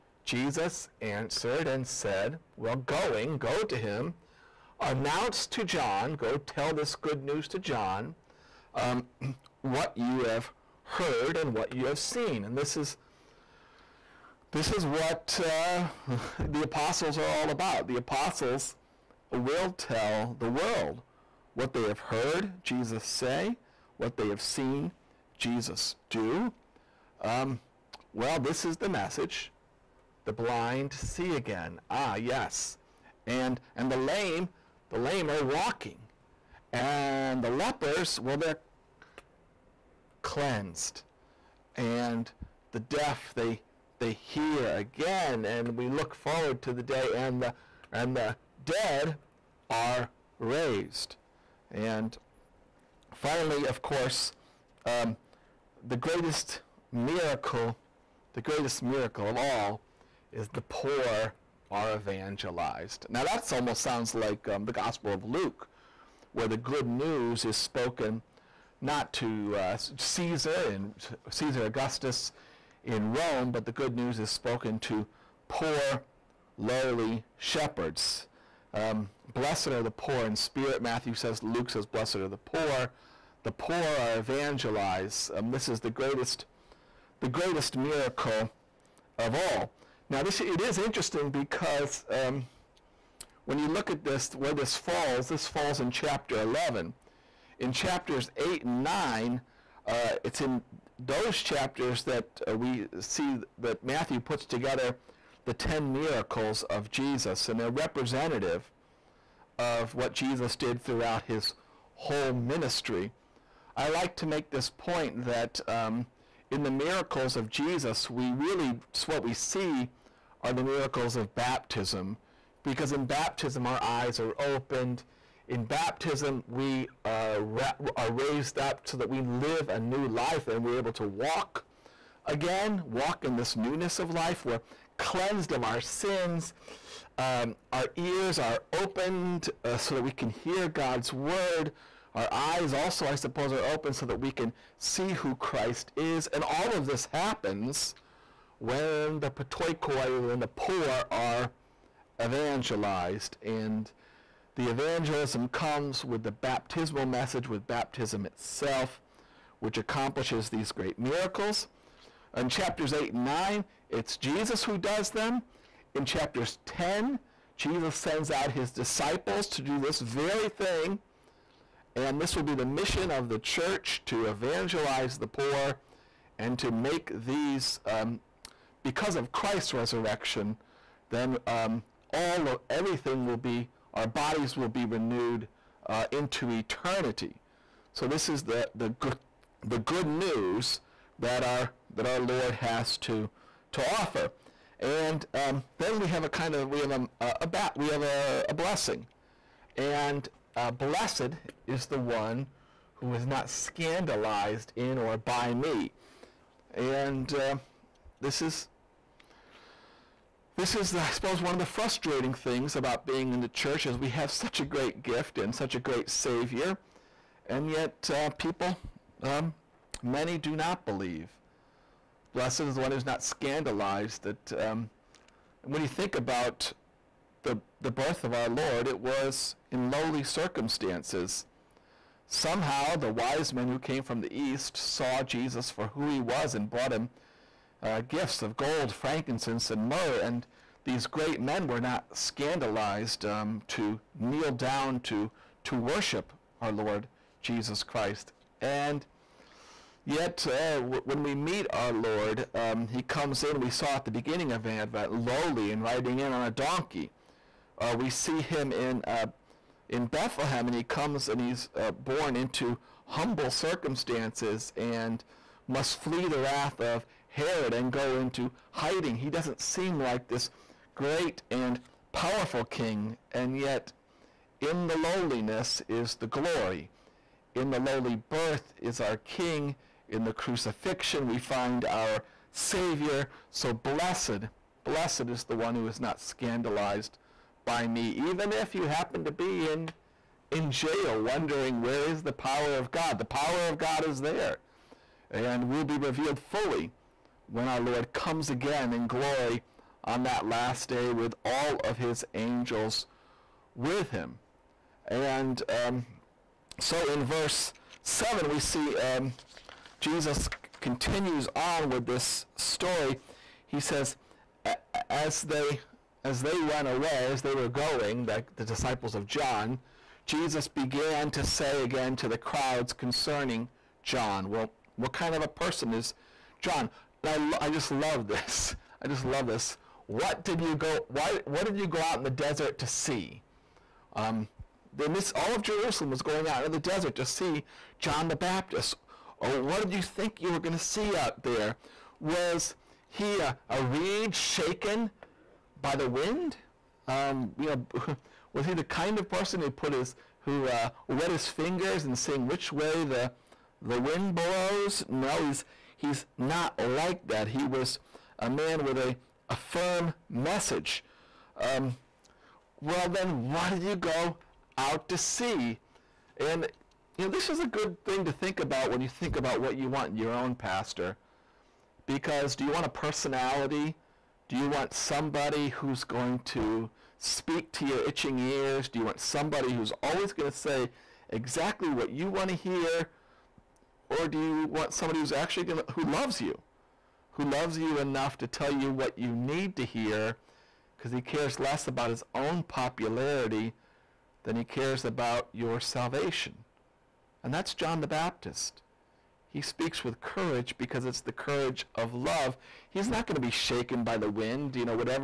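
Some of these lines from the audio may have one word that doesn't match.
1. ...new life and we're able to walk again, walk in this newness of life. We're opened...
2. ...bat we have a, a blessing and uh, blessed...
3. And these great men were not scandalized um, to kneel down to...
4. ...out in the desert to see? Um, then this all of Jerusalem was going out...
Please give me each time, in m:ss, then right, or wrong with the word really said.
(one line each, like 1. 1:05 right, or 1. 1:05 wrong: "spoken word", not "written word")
1. 2:09 wrong: "cleansed", not "opened"
2. 3:17 right
3. 4:00 right
4. 5:32 right.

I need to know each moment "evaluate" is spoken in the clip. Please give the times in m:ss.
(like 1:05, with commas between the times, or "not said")
not said.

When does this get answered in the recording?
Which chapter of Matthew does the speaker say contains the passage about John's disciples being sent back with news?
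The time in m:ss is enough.
1:35.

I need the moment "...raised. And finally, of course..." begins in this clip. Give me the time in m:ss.
0:50.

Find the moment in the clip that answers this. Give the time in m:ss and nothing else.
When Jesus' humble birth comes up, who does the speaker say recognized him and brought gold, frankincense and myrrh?
3:52.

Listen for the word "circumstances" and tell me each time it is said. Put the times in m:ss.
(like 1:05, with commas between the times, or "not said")
3:50, 4:23.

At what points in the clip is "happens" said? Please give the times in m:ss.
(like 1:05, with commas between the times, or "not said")
2:27, 4:48.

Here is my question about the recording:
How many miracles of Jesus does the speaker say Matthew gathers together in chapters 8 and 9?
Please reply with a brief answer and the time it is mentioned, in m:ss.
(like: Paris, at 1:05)
10, at 1:45.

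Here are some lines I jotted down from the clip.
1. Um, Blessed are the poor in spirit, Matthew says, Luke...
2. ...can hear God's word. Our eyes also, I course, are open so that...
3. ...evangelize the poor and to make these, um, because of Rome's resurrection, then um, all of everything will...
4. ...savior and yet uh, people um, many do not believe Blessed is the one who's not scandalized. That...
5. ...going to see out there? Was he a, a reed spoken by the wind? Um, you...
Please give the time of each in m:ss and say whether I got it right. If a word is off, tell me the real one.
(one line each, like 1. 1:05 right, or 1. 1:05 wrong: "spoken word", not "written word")
1. 1:18 right
2. 2:20 wrong: "suppose", not "course"
3. 2:54 wrong: "Christ", not "Rome"
4. 3:36 right
5. 5:40 wrong: "shaken", not "spoken".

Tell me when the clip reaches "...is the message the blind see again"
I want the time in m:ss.
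0:28.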